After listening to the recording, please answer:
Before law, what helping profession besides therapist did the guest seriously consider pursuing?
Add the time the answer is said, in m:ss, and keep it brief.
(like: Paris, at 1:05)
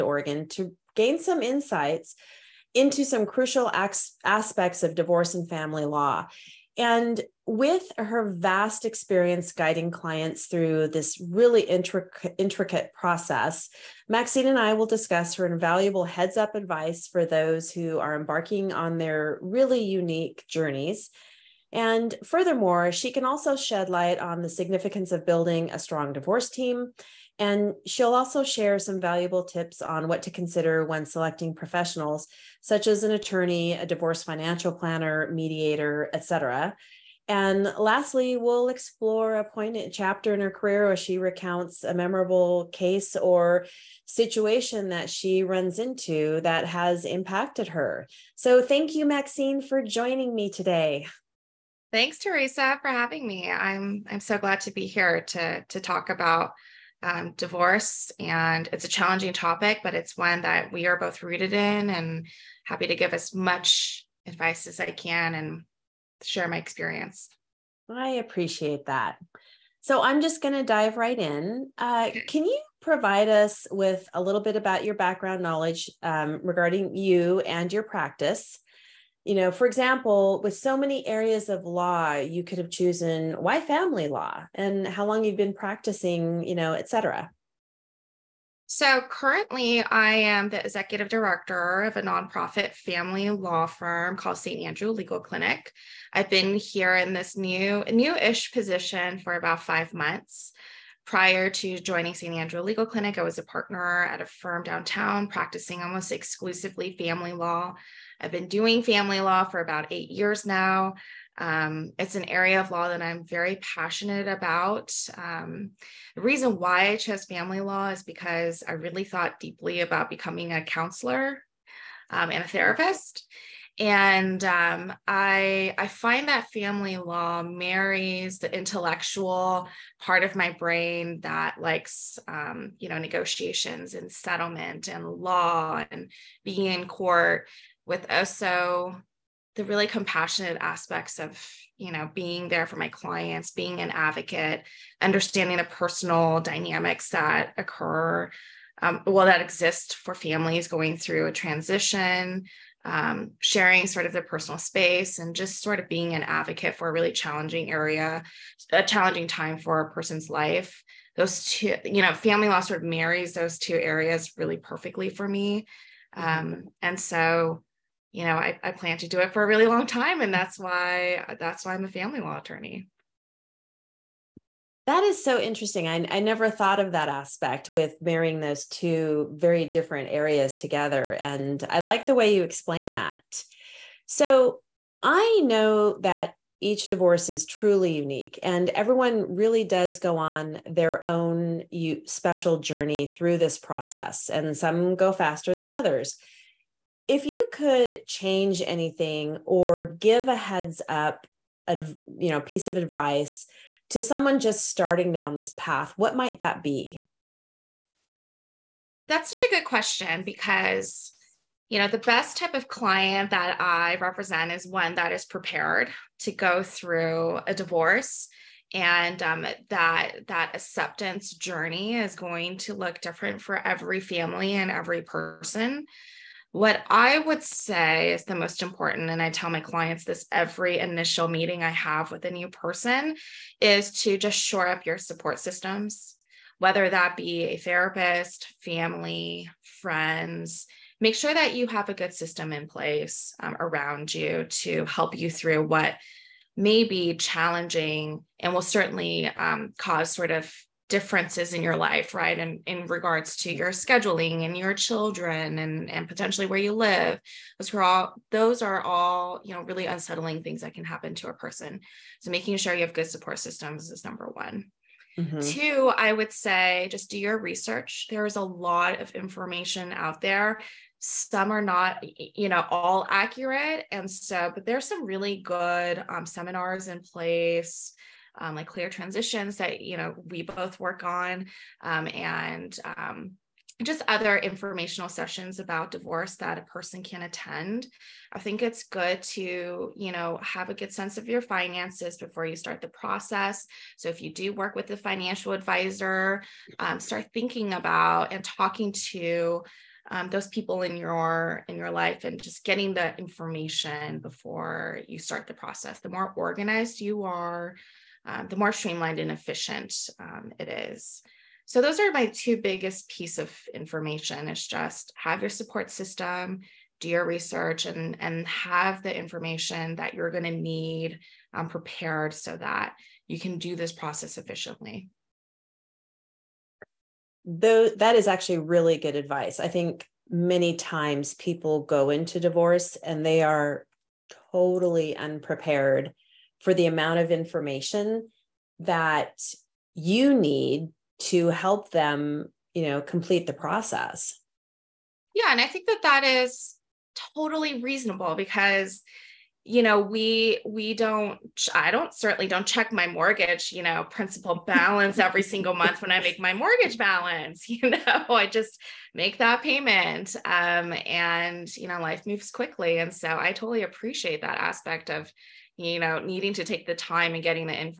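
counselor, at 2:00.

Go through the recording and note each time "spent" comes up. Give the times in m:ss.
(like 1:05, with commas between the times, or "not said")
not said.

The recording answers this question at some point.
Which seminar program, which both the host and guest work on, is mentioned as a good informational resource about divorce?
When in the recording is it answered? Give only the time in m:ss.
4:38.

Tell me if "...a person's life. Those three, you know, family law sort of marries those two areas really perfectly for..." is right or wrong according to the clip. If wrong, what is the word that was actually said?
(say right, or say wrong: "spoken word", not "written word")
wrong: "two", not "three".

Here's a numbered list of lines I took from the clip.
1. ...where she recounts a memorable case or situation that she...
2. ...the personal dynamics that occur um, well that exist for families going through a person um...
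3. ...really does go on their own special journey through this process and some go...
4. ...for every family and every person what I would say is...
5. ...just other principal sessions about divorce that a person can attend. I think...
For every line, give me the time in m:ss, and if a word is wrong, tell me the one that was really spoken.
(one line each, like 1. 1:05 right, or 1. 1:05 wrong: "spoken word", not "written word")
1. 0:40 right
2. 2:25 wrong: "transition", not "person"
3. 3:09 right
4. 3:43 right
5. 4:43 wrong: "informational", not "principal".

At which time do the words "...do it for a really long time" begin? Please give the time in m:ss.
2:49.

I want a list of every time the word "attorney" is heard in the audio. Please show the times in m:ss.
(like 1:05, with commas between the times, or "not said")
0:33, 2:52.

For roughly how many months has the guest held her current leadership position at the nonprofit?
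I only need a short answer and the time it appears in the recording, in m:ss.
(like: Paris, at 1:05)
5, at 1:39.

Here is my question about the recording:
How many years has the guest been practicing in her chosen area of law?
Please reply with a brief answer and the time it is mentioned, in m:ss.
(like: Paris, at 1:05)
8, at 1:49.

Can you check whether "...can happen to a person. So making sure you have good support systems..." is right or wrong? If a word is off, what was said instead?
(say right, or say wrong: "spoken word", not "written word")
right.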